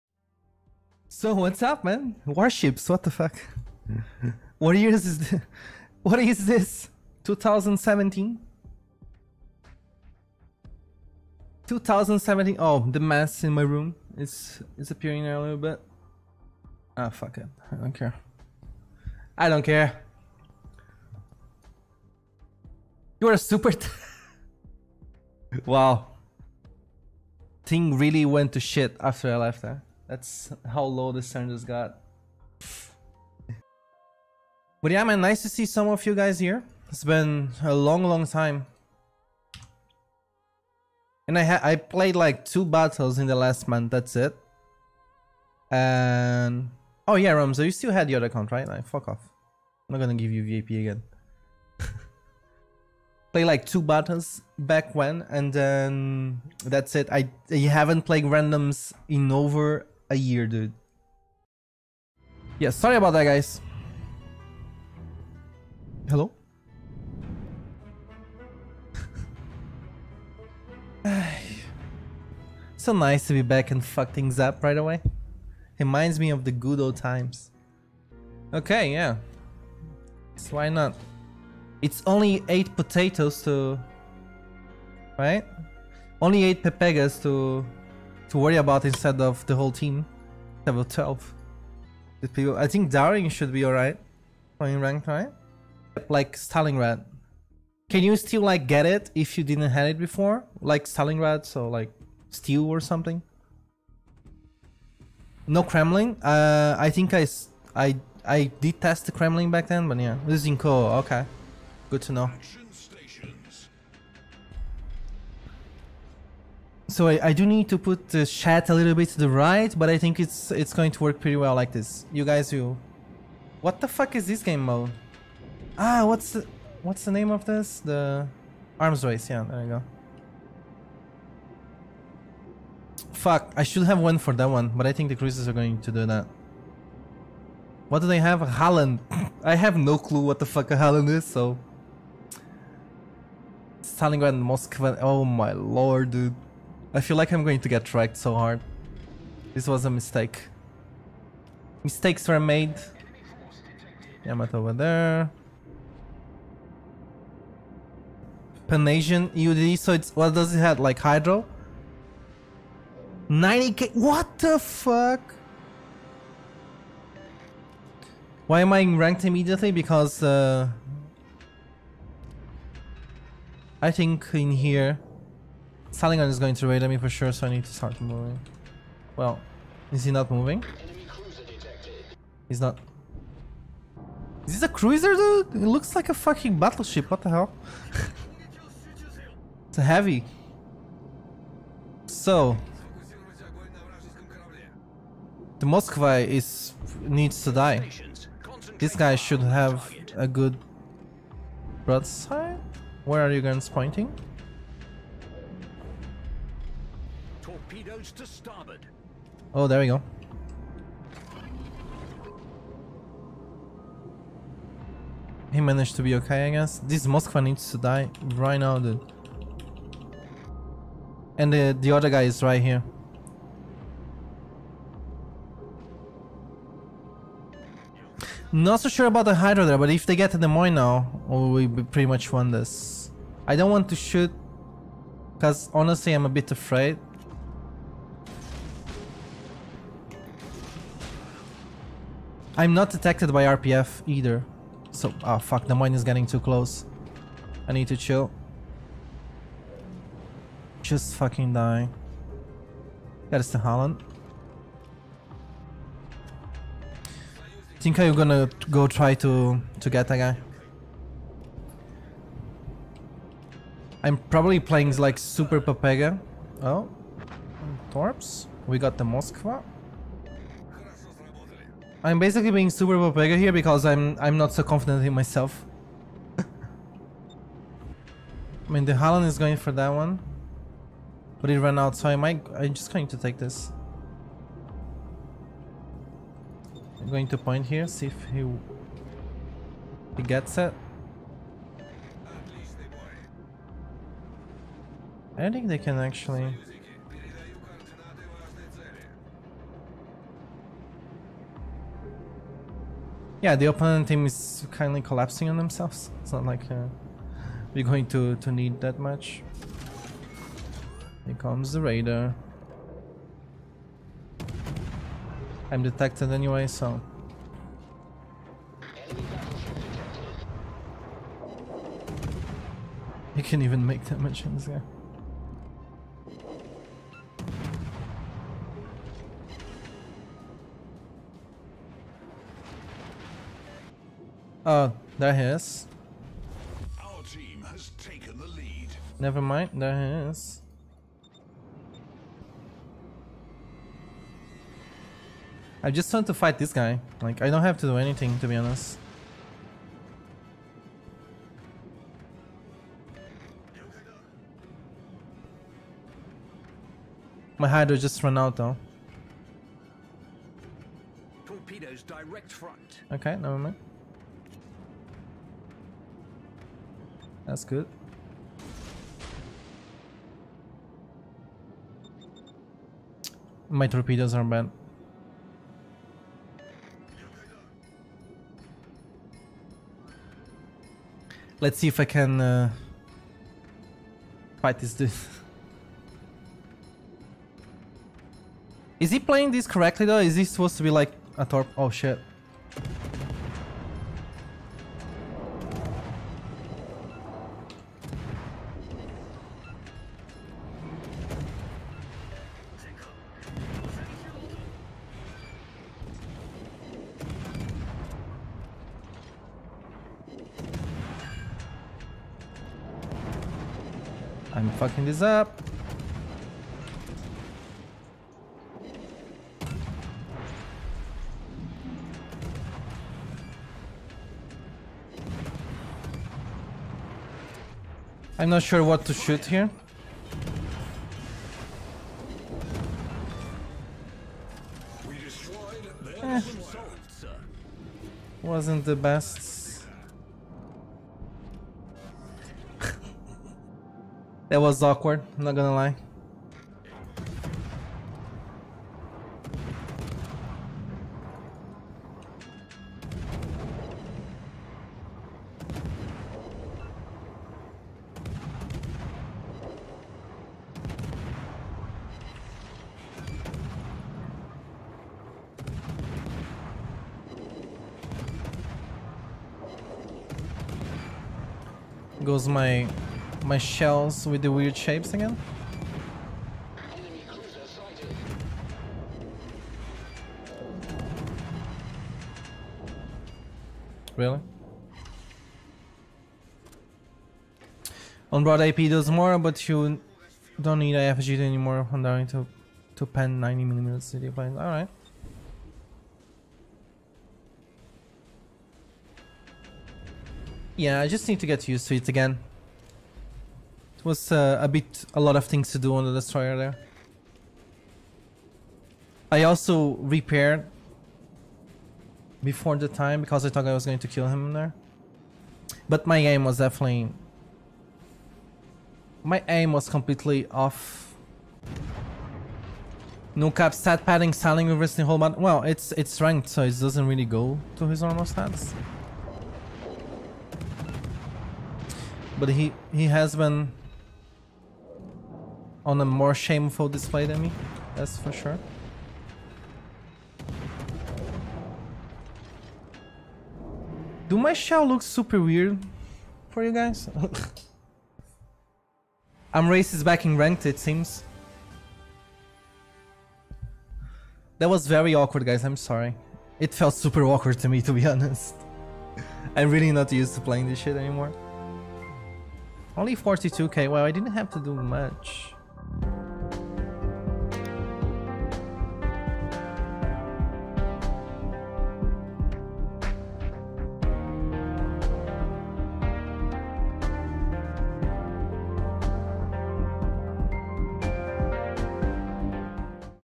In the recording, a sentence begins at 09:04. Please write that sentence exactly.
Do my shell look super weird for you guys?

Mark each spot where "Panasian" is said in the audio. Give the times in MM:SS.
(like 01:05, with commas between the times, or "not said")
02:38.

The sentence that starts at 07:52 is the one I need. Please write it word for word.
Goes my my shells with the weird shapes again?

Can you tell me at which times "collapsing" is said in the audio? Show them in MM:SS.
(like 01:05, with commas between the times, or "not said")
05:05.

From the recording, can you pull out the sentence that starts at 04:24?
I'm probably playing like Super Pepega.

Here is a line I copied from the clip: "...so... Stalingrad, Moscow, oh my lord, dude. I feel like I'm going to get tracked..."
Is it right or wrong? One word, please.
right.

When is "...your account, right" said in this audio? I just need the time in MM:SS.
00:48.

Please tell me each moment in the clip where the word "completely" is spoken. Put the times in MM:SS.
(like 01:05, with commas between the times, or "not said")
08:39.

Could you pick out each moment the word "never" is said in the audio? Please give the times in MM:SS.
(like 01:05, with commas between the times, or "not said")
05:39, 06:03.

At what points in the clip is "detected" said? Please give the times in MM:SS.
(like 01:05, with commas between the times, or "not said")
04:02, 05:15.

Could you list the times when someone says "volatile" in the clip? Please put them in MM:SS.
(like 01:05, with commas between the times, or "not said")
not said.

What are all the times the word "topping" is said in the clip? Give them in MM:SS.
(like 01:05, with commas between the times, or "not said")
not said.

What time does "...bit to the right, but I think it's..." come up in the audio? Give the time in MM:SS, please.
01:58.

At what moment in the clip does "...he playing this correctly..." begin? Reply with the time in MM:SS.
06:29.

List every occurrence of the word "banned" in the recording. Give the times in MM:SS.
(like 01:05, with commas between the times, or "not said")
06:14.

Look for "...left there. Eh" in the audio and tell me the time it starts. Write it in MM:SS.
00:29.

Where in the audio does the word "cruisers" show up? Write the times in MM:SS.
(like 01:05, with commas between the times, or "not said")
02:15, 03:04.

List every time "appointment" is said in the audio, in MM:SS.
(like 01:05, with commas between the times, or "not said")
not said.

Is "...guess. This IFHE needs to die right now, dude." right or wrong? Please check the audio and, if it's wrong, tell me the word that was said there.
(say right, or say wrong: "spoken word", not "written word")
wrong: "Moskva", not "IFHE".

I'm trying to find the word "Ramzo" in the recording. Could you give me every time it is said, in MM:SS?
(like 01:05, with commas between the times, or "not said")
00:47.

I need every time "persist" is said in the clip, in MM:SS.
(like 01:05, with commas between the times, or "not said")
not said.